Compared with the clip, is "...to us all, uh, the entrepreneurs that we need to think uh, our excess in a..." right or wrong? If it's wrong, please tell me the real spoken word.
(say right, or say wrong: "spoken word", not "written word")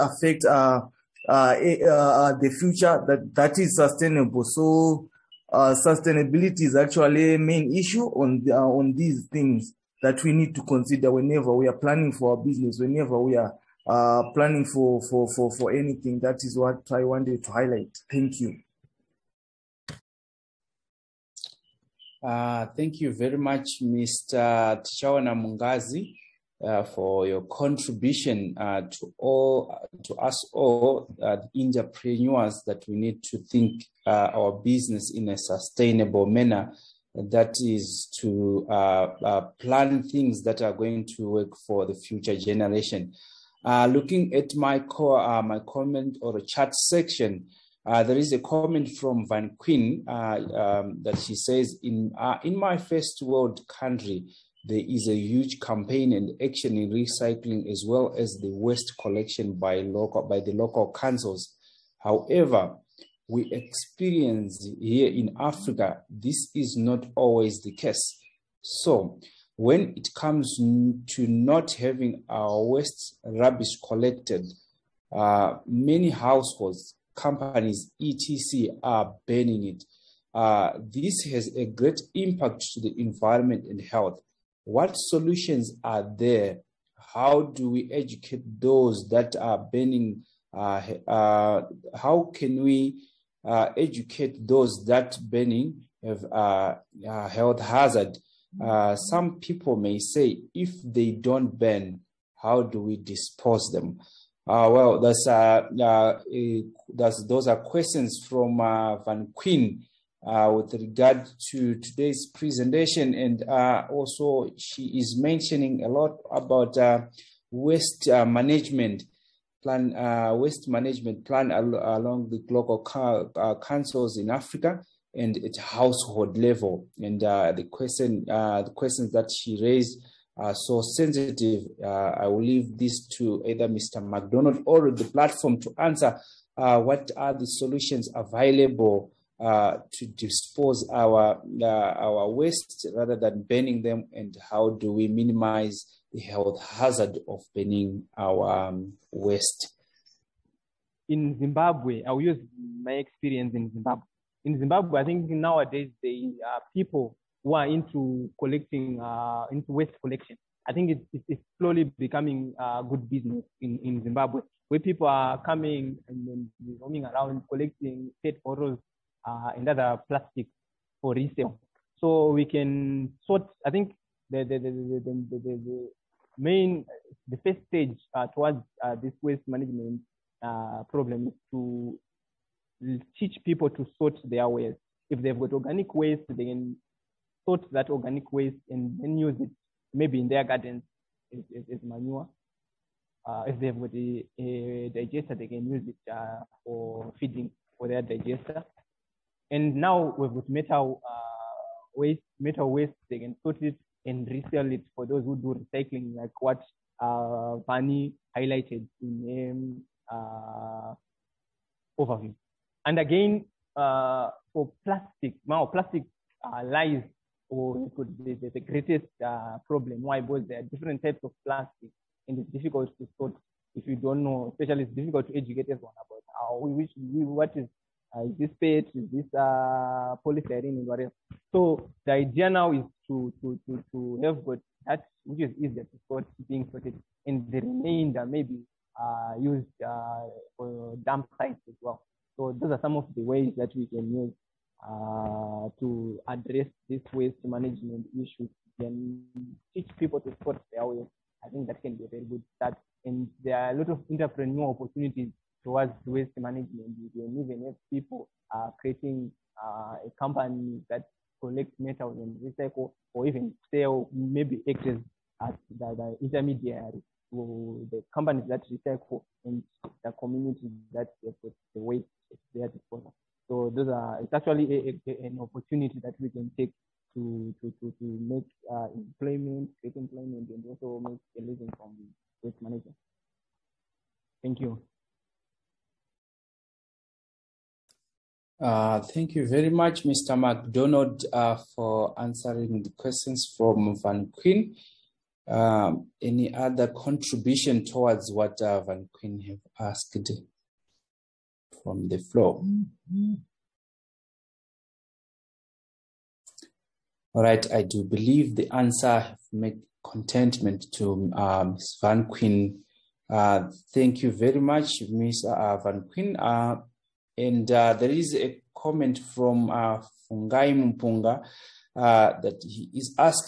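wrong: "business", not "excess".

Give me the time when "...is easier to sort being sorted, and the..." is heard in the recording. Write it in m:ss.
3:55.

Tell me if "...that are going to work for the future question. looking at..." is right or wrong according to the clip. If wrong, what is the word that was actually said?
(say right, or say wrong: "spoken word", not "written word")
wrong: "generation", not "question".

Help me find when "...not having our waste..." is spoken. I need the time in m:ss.
1:11.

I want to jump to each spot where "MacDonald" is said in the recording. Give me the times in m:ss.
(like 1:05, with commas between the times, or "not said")
2:14, 4:50.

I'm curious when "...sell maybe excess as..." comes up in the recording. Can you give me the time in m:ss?
4:23.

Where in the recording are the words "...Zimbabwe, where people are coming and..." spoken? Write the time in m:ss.
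2:44.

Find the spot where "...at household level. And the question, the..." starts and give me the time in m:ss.
2:05.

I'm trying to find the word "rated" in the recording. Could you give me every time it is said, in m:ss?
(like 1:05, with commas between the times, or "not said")
not said.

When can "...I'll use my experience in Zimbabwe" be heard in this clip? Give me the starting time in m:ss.
2:32.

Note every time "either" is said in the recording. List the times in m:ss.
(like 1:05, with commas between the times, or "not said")
2:13.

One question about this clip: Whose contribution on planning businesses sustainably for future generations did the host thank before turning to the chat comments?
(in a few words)
Tichaona Mungazi.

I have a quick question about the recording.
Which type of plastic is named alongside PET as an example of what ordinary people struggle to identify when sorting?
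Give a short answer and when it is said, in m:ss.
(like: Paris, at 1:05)
polystyrene, at 3:50.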